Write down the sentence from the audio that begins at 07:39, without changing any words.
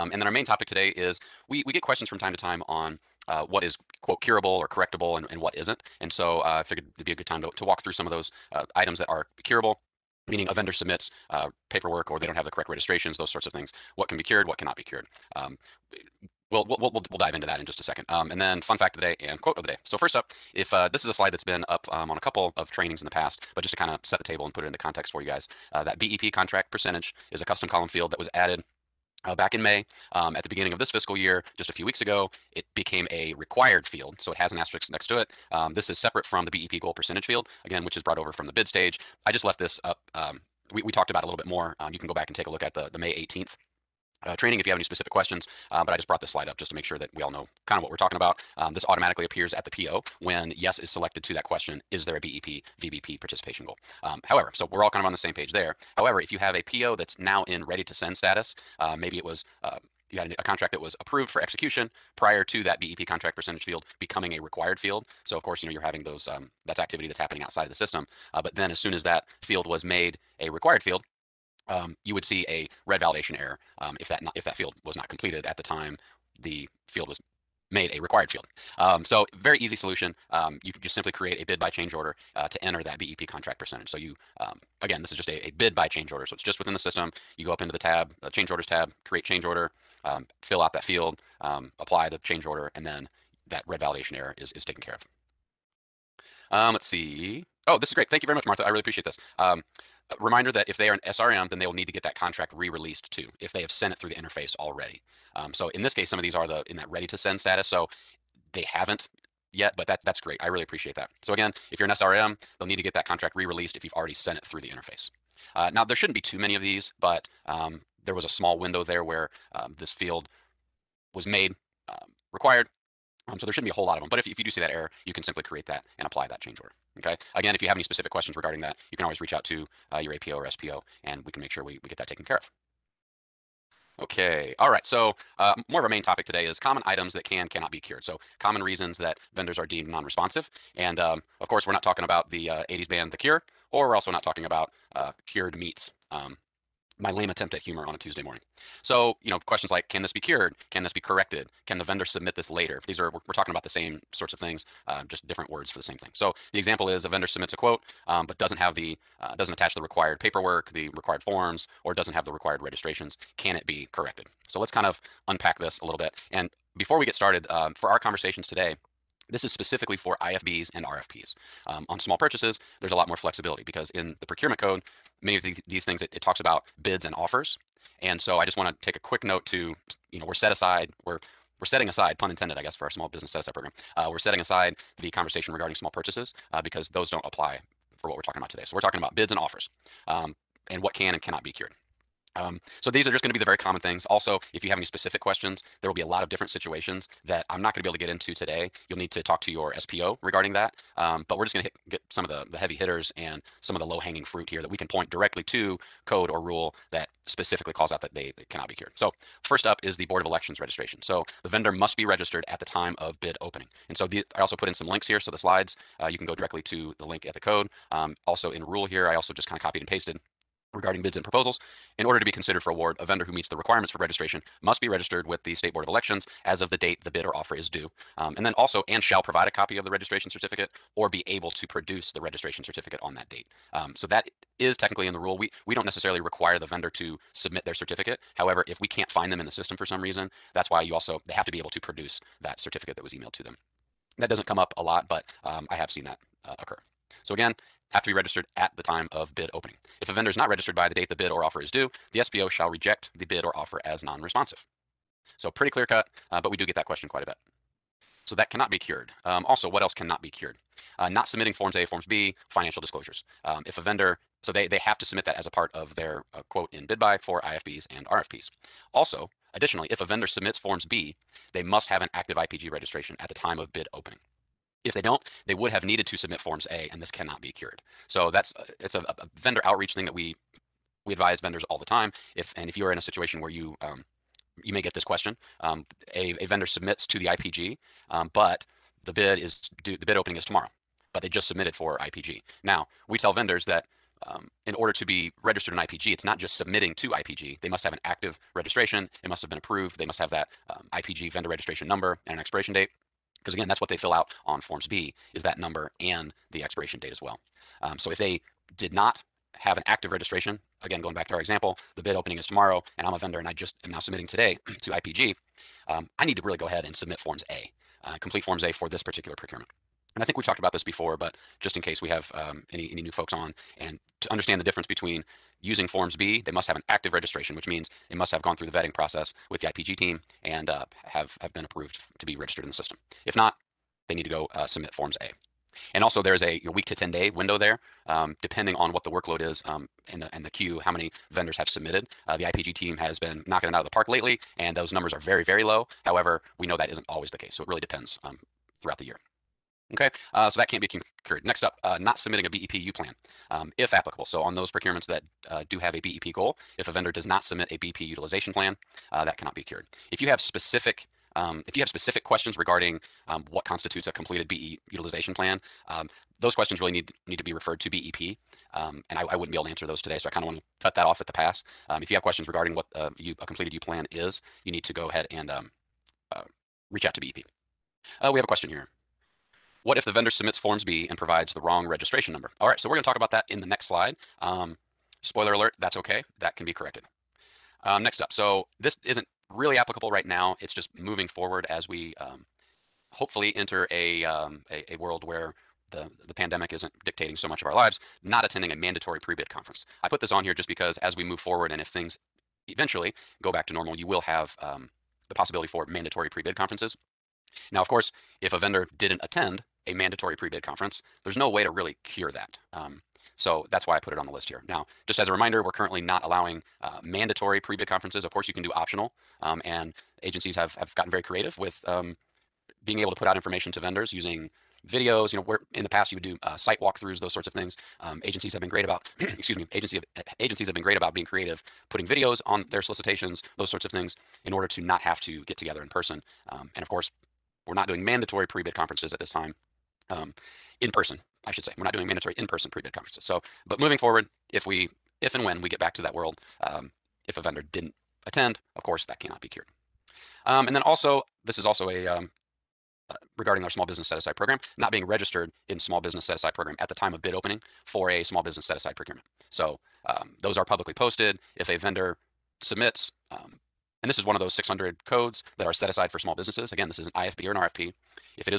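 So um, those are publicly posted.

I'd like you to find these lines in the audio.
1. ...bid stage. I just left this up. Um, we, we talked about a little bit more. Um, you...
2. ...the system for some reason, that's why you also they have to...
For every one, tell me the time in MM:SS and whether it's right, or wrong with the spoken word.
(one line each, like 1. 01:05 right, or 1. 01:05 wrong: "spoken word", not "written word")
1. 00:38 right
2. 03:59 right.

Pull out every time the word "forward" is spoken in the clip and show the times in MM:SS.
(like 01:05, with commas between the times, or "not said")
06:31, 06:41, 07:23.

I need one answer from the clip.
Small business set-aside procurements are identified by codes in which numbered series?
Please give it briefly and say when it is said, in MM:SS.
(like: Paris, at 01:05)
600, at 07:44.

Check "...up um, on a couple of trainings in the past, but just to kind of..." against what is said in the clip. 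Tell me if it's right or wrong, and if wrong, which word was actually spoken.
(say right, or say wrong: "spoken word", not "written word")
right.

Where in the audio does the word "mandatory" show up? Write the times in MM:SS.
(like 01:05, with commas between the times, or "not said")
06:38, 06:45, 06:49, 06:57, 07:18, 07:22.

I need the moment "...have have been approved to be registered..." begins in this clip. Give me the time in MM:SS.
05:31.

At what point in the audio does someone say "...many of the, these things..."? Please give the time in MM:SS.
02:55.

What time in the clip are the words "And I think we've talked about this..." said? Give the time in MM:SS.
05:20.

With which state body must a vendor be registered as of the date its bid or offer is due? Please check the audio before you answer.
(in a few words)
State Board of Elections.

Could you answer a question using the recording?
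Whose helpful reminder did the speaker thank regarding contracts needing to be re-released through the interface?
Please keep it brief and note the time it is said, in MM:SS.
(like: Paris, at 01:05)
Martha, at 01:38.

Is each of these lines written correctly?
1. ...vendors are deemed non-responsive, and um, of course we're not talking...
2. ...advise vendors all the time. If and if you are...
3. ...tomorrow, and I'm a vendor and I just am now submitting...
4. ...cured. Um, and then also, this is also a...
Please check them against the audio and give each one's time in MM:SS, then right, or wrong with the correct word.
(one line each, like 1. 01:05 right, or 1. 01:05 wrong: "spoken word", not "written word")
1. 02:19 right
2. 04:41 right
3. 05:12 right
4. 07:29 right.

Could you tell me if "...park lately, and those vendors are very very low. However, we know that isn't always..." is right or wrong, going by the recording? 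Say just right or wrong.
wrong.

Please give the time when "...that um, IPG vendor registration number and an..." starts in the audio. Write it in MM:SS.
05:00.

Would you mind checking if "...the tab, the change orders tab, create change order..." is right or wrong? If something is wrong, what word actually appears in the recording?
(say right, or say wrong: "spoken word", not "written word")
right.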